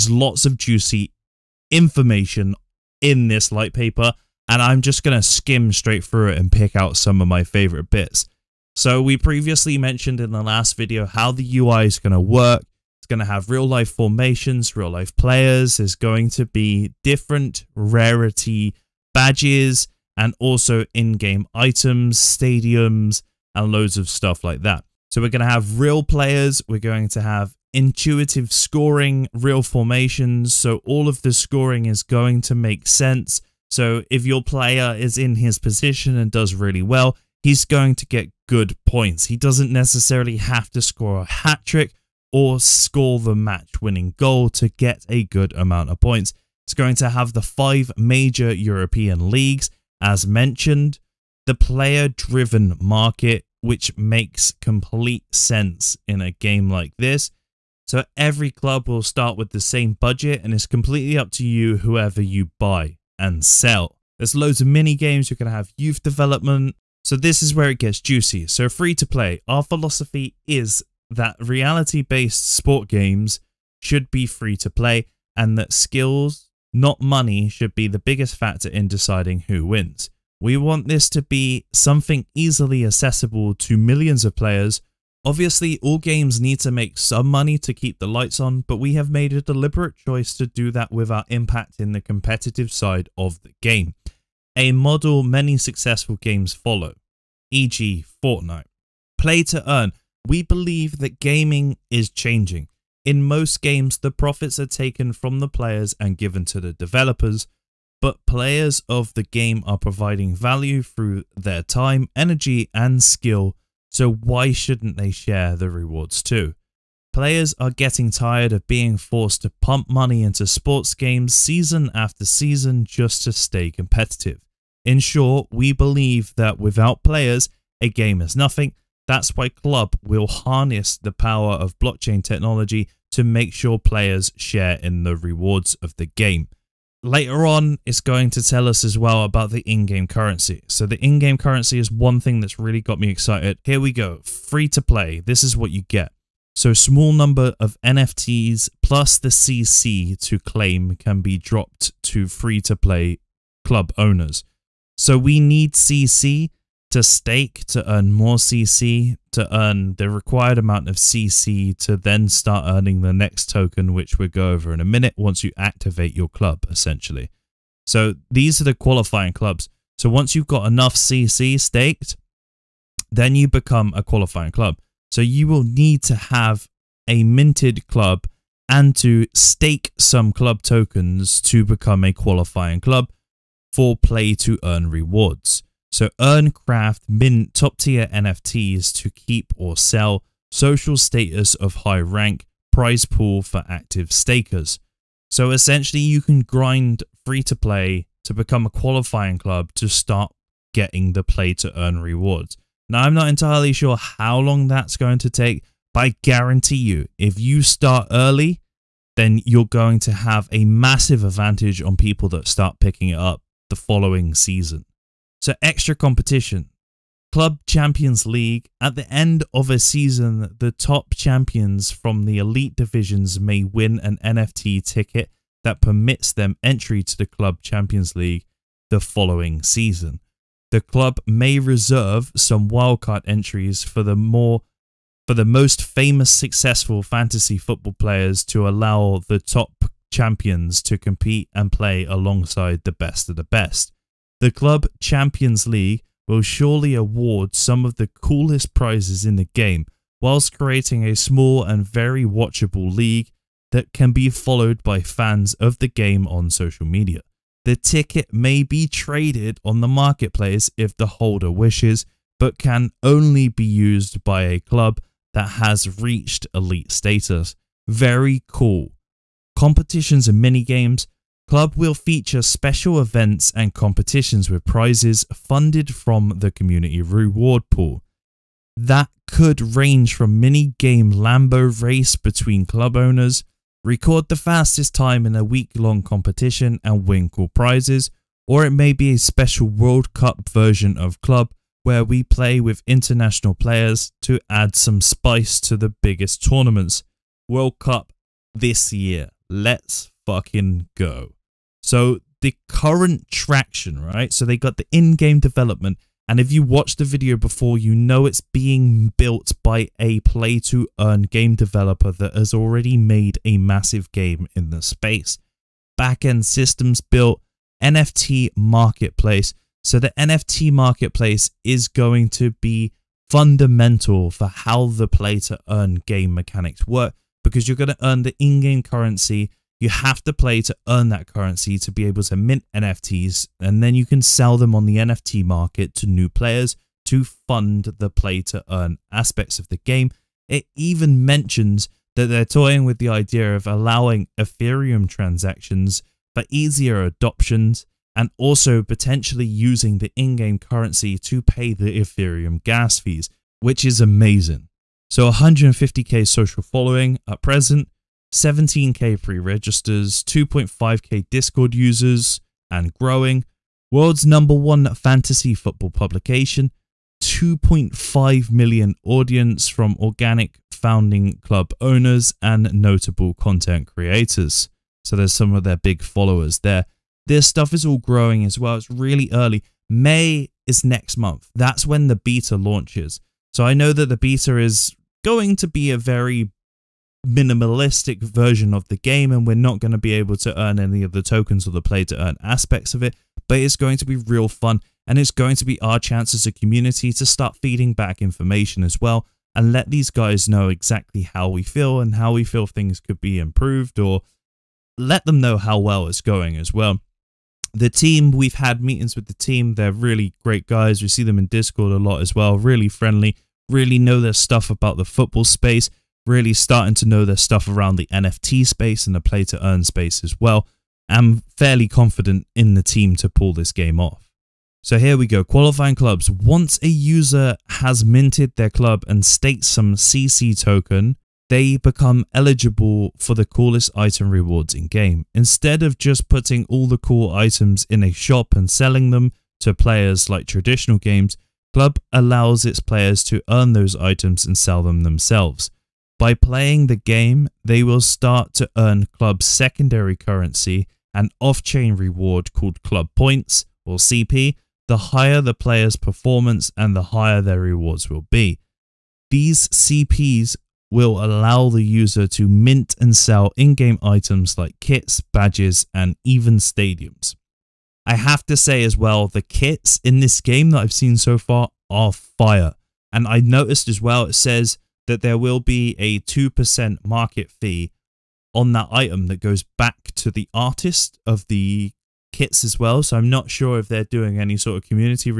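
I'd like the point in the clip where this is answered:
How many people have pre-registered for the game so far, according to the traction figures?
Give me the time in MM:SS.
05:58.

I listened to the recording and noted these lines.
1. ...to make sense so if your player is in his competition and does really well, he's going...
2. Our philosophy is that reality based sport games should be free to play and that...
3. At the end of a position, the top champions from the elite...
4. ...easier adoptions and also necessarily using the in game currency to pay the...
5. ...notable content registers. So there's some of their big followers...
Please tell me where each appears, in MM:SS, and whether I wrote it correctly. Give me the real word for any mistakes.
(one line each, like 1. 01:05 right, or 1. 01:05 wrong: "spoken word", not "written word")
1. 00:32 wrong: "position", not "competition"
2. 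01:09 right
3. 03:38 wrong: "season", not "position"
4. 05:46 wrong: "potentially", not "necessarily"
5. 06:12 wrong: "creators", not "registers".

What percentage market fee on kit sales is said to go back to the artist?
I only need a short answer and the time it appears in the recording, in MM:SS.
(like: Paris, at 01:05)
2%, at 07:56.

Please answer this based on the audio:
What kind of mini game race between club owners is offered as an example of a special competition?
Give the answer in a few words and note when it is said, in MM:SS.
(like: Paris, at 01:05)
Lambo race, at 04:41.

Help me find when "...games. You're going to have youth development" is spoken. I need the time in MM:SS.
01:04.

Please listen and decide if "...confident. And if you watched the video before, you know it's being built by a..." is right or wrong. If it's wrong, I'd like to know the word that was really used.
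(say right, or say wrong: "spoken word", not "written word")
wrong: "development", not "confident".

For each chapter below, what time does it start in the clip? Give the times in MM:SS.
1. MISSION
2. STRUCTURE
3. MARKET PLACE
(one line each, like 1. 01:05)
1. 01:07
2. 03:07
3. 05:07.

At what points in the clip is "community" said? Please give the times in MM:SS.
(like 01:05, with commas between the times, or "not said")
04:36, 06:36, 08:04.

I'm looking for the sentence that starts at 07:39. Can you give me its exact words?
These CPs will allow the user to mint and sell in-game items like kits, badges, and even stadiums.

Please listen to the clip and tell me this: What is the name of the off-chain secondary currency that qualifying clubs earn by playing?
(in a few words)
club points.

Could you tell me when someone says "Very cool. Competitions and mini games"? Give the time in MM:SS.
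04:27.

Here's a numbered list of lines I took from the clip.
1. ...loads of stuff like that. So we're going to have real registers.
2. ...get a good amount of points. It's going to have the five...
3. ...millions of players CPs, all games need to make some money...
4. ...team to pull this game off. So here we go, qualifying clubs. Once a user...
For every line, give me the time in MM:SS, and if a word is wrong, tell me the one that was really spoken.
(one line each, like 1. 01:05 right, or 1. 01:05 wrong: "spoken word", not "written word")
1. 00:23 wrong: "players", not "registers"
2. 00:44 right
3. 01:23 wrong: "Obviously", not "CPs"
4. 07:02 right.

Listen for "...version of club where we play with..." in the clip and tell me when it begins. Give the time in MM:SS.
04:50.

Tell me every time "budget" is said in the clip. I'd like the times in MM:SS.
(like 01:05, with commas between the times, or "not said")
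00:59.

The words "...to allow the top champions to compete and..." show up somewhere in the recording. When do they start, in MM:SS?
03:58.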